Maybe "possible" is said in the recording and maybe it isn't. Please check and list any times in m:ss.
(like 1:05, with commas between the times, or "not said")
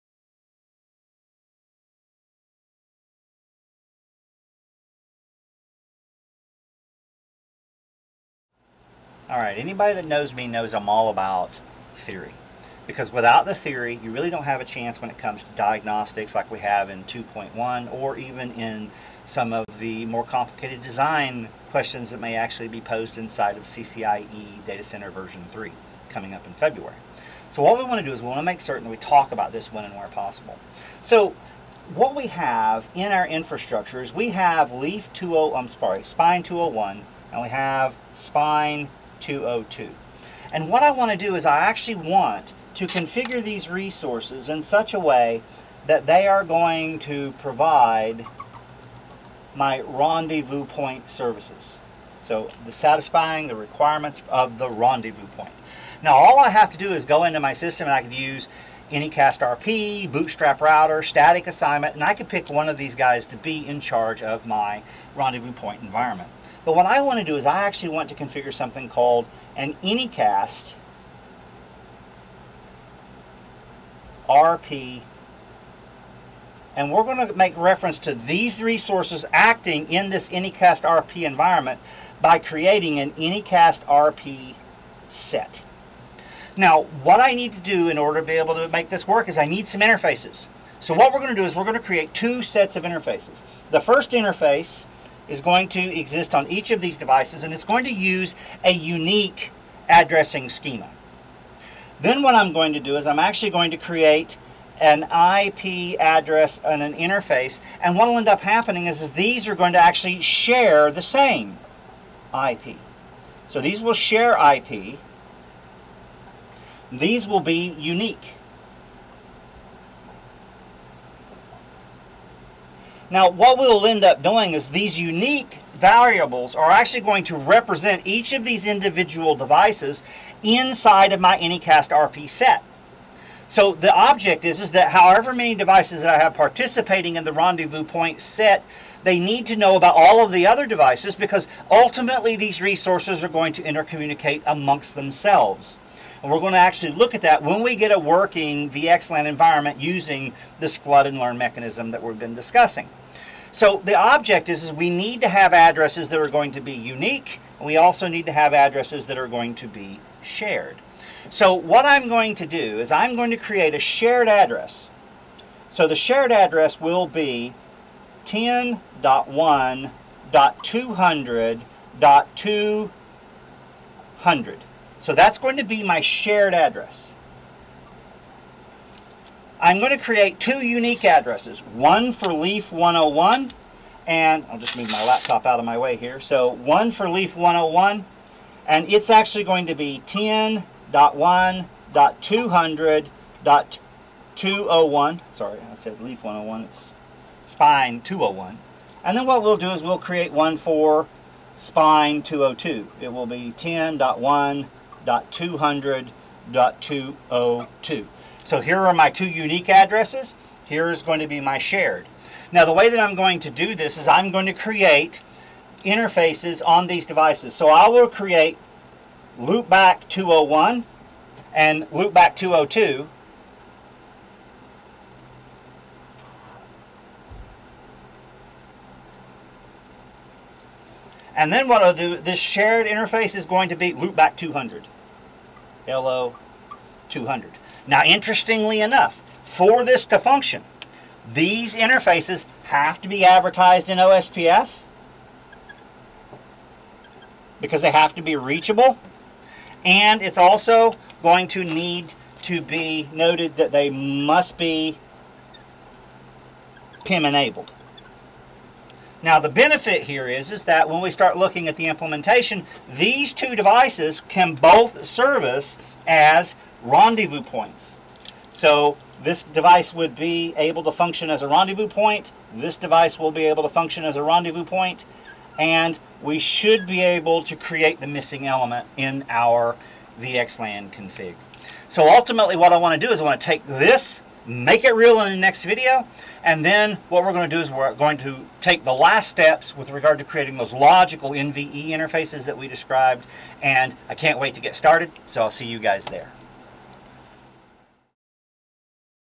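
0:30.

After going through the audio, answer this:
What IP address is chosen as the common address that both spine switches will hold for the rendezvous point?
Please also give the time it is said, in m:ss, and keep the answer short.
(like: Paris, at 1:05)
10.1.200.200, at 2:48.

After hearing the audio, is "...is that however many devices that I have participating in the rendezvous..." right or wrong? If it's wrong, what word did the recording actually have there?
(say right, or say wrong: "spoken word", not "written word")
right.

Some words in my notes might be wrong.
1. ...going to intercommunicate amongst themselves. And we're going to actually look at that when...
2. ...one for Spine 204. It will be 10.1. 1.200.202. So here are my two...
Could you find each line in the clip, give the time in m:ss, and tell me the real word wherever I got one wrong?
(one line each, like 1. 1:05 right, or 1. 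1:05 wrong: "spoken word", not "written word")
1. 2:23 right
2. 3:20 wrong: "202", not "204".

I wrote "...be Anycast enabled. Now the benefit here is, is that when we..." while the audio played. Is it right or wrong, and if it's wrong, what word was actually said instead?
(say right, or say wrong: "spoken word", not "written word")
wrong: "PIM", not "Anycast".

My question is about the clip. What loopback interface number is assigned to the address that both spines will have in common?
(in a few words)
200.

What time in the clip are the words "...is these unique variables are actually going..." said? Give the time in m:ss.
2:04.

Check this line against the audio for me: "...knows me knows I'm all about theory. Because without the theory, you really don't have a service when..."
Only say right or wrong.
wrong.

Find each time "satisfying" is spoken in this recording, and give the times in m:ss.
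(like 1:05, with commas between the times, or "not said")
0:52.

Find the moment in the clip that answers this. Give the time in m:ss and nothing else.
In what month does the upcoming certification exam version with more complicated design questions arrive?
0:26.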